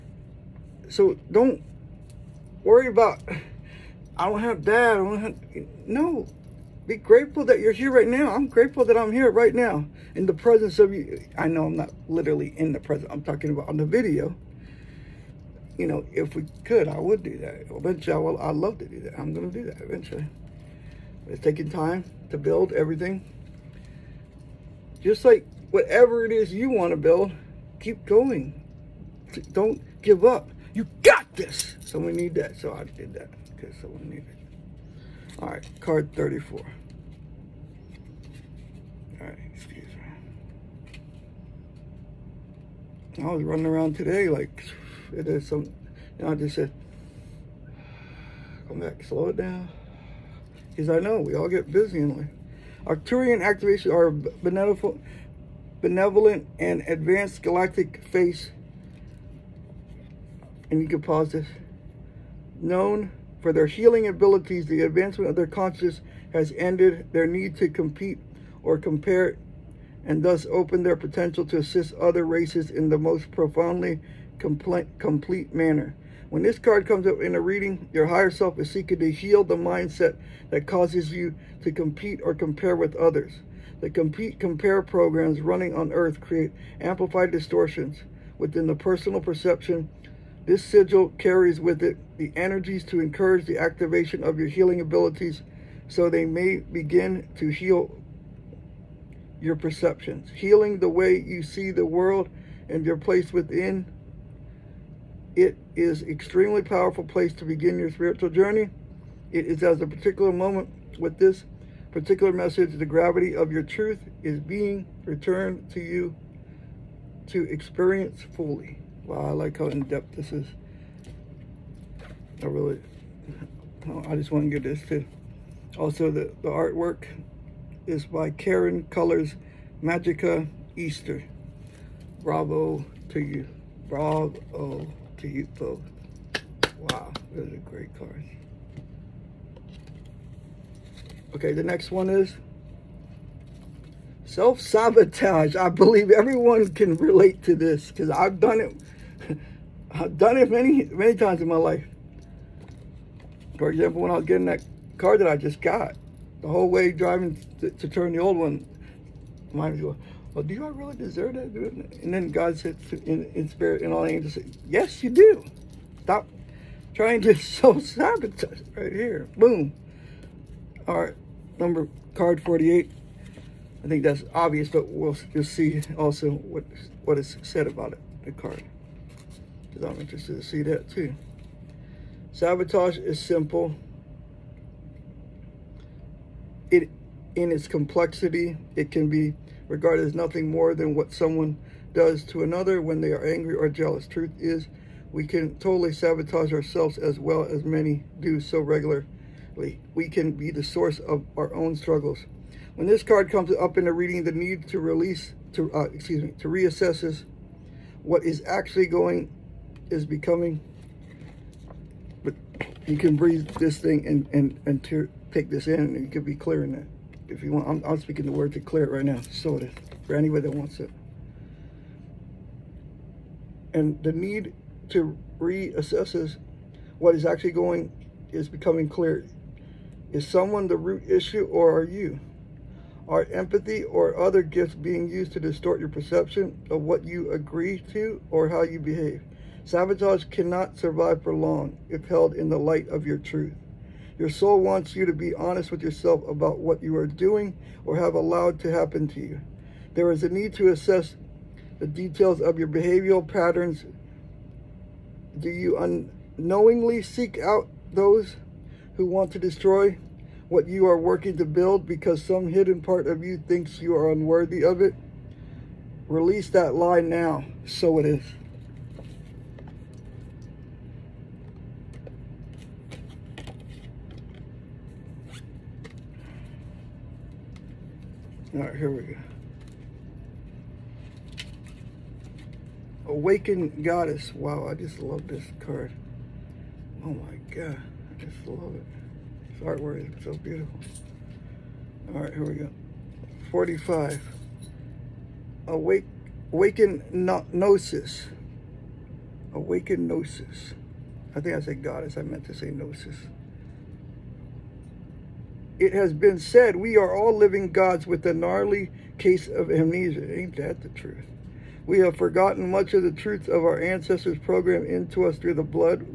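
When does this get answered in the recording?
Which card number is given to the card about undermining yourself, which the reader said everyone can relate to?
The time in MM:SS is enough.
02:52.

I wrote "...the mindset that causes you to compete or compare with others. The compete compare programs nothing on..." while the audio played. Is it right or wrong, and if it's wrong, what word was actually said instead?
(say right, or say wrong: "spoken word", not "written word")
wrong: "running", not "nothing".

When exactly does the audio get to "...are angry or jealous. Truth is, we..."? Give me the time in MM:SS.
03:13.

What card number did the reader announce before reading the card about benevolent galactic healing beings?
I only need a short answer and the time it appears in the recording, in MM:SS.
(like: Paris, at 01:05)
34, at 00:35.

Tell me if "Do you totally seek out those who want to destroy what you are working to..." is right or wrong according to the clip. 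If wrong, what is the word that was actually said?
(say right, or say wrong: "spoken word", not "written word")
wrong: "unknowingly", not "totally".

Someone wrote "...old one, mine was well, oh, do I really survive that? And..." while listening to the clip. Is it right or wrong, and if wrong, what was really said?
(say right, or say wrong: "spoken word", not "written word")
wrong: "deserve", not "survive".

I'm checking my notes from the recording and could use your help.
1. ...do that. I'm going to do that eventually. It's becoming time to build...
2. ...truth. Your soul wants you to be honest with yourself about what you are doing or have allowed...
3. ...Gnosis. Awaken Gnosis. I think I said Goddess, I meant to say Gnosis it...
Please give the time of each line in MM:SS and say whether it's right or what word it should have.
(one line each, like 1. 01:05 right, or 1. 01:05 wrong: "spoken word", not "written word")
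1. 00:18 wrong: "taking", not "becoming"
2. 04:03 right
3. 04:57 right.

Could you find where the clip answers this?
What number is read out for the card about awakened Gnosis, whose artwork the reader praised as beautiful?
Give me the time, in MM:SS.
04:53.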